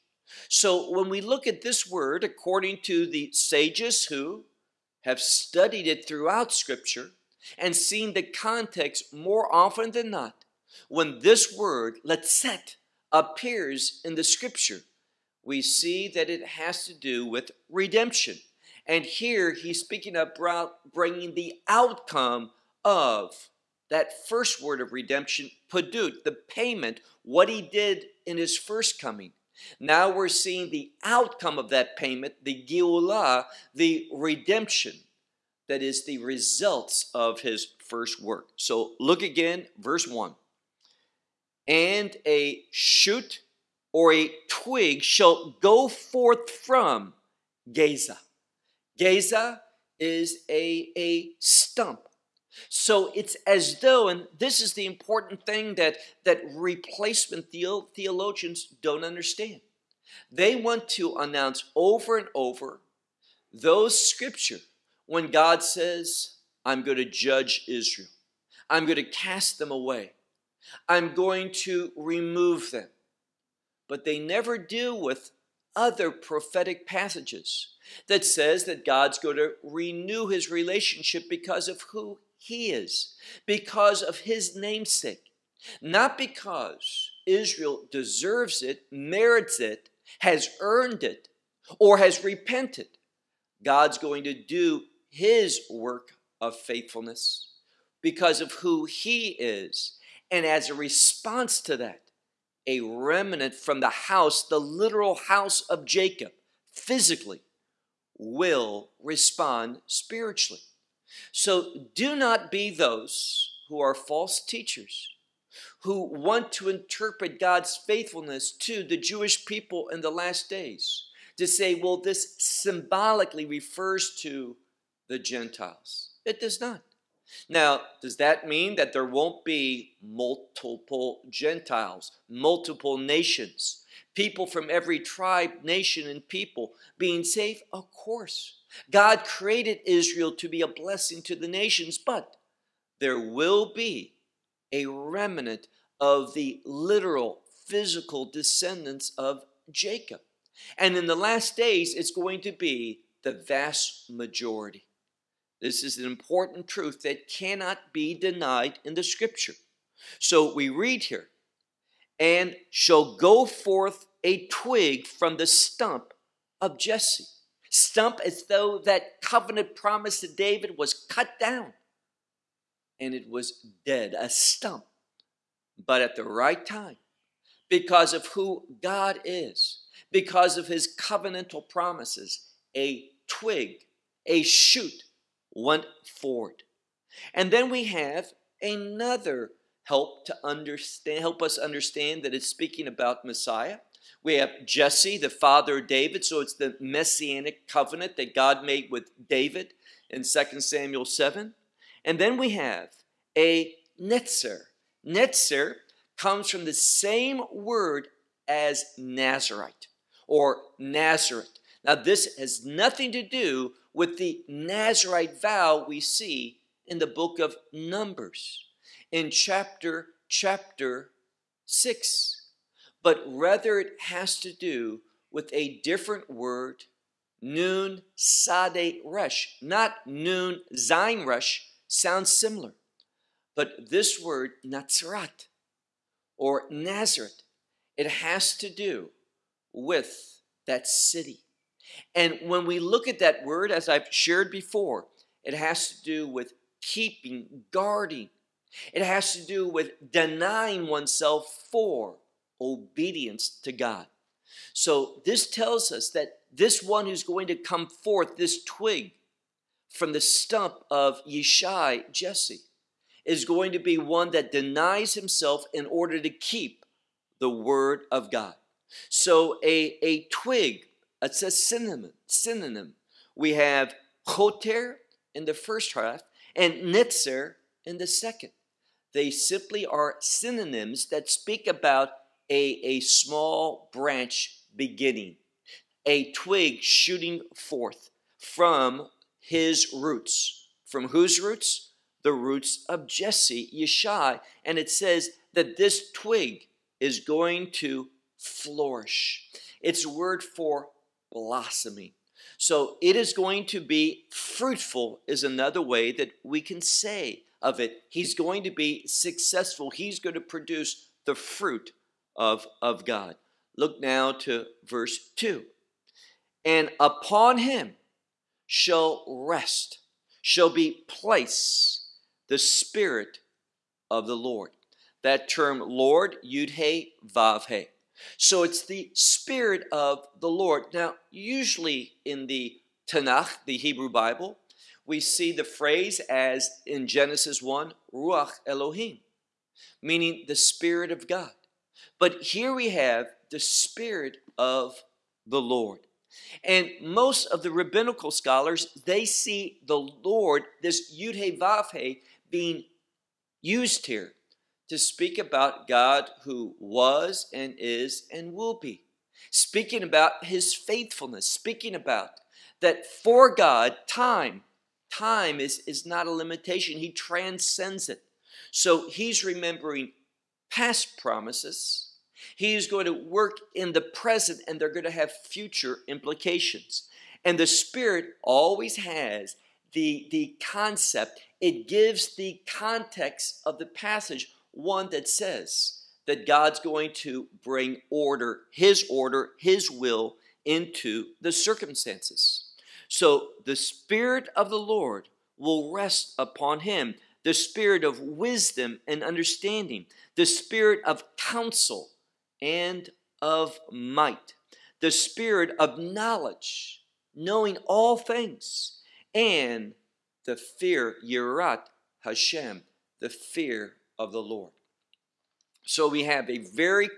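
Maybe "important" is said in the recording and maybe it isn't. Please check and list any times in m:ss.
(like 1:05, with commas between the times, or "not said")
0:54, 2:36.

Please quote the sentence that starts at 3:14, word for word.
We have Jesse, the father of David, so it's the messianic covenant that God made with David in 2 Samuel 7.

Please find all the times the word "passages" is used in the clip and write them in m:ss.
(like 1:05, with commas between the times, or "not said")
1:16, 6:23.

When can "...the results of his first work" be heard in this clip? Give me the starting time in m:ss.
0:36.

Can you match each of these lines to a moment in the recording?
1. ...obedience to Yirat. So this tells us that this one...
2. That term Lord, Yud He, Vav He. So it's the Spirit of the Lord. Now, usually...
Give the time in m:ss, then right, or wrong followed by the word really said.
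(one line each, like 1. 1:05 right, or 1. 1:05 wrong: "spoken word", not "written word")
1. 4:12 wrong: "God", not "Yirat"
2. 5:25 right.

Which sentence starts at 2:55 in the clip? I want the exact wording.
But at the right time, because of who God is, because of his covenantal promises, a twig, a shoot went forward.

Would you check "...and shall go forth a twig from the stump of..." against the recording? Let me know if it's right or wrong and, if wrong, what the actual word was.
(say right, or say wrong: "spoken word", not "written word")
right.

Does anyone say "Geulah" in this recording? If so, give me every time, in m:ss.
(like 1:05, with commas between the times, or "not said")
0:32.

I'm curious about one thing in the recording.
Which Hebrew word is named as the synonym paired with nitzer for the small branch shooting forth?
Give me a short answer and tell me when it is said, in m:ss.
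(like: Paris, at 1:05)
choter, at 4:34.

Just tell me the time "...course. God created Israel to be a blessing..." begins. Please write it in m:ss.
2:17.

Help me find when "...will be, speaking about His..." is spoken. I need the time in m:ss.
5:58.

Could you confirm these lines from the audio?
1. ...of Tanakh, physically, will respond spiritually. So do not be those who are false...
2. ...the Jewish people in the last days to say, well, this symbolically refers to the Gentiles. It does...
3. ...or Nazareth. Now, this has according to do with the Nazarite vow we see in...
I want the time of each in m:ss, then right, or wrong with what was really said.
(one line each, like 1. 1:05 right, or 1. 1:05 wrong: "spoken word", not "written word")
1. 1:45 wrong: "Jacob", not "Tanakh"
2. 1:58 right
3. 3:30 wrong: "nothing", not "according".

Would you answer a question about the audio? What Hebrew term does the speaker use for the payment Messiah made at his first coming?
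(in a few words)
padut.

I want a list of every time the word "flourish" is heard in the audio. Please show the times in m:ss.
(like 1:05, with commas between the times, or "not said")
4:58.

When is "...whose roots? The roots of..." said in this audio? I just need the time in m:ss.
4:51.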